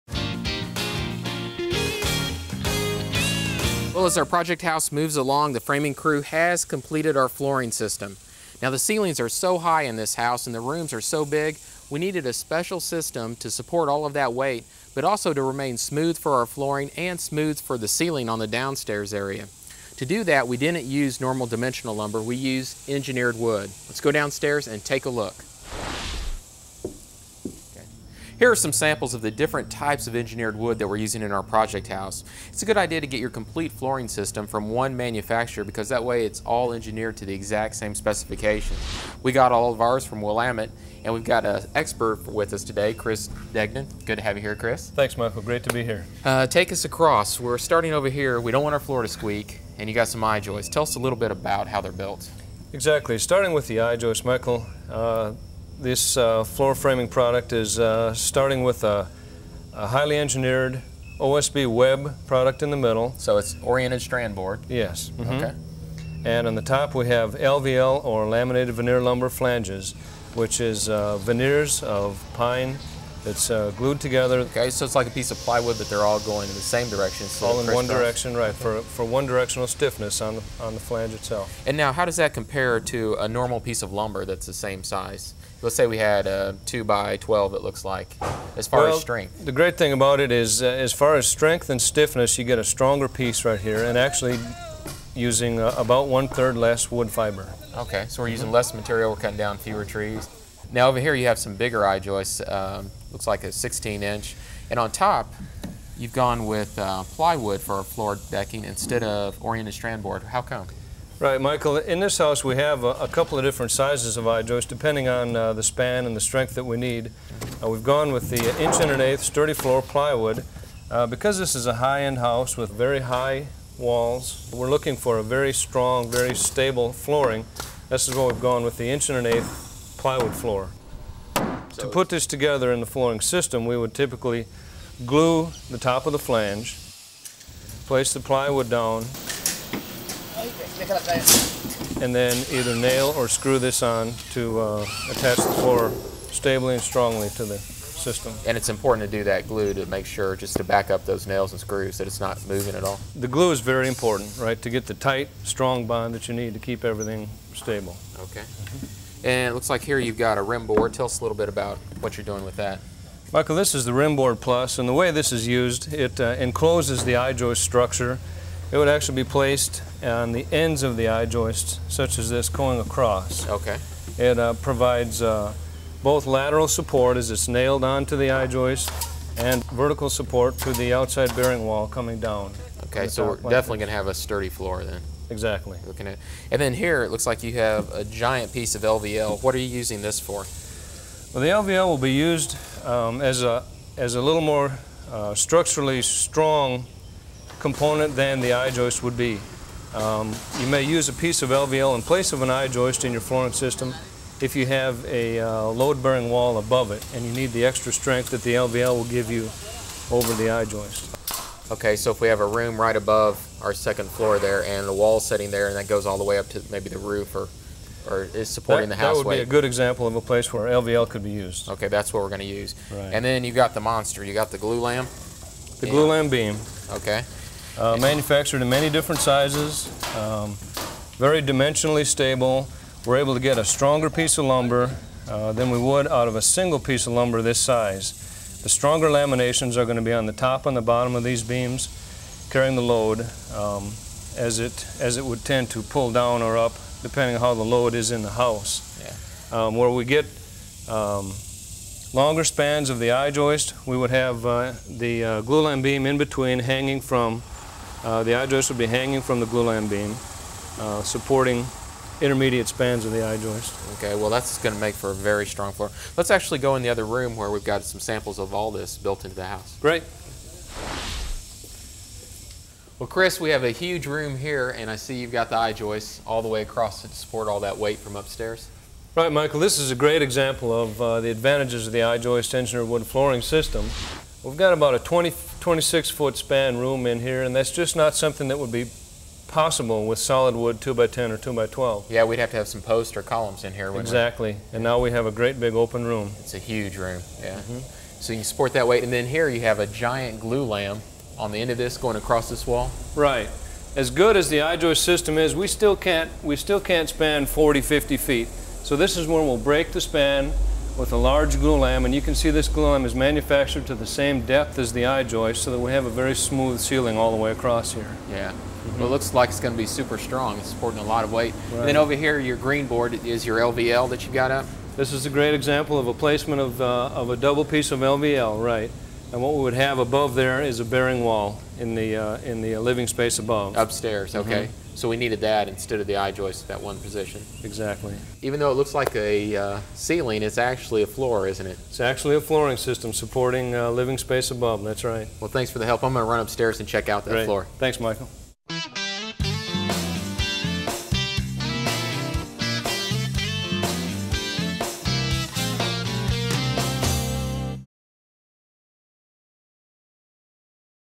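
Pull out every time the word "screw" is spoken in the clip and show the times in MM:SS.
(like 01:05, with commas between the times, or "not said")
02:23, 02:31.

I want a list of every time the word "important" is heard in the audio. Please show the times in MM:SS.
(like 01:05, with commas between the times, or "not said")
02:28, 02:33.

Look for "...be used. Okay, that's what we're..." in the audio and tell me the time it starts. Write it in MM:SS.
03:41.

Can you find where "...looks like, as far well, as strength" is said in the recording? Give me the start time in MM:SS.
01:27.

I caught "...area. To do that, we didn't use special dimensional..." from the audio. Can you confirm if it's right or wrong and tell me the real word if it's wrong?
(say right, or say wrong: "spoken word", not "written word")
wrong: "normal", not "special".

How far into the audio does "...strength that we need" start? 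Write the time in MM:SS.
01:56.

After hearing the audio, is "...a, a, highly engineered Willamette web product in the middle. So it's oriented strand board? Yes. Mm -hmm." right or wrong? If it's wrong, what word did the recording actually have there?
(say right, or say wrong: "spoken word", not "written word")
wrong: "OSB", not "Willamette".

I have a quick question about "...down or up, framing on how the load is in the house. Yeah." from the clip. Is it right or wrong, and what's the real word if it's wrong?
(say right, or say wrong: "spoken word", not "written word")
wrong: "depending", not "framing".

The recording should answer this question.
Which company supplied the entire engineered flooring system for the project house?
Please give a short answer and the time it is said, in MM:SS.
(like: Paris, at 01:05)
Willamette, at 00:40.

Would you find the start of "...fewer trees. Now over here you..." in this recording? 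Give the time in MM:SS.
01:39.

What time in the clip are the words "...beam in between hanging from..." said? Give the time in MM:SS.
04:15.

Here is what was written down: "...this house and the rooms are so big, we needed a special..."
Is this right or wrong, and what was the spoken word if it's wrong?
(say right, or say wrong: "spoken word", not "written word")
right.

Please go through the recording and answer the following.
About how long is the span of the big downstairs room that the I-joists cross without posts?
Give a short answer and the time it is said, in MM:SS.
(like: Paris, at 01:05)
26 feet, at 04:45.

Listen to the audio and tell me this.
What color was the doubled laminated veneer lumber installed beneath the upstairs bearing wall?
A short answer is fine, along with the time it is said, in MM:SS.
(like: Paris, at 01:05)
green, at 05:22.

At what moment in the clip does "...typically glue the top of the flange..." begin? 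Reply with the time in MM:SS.
02:13.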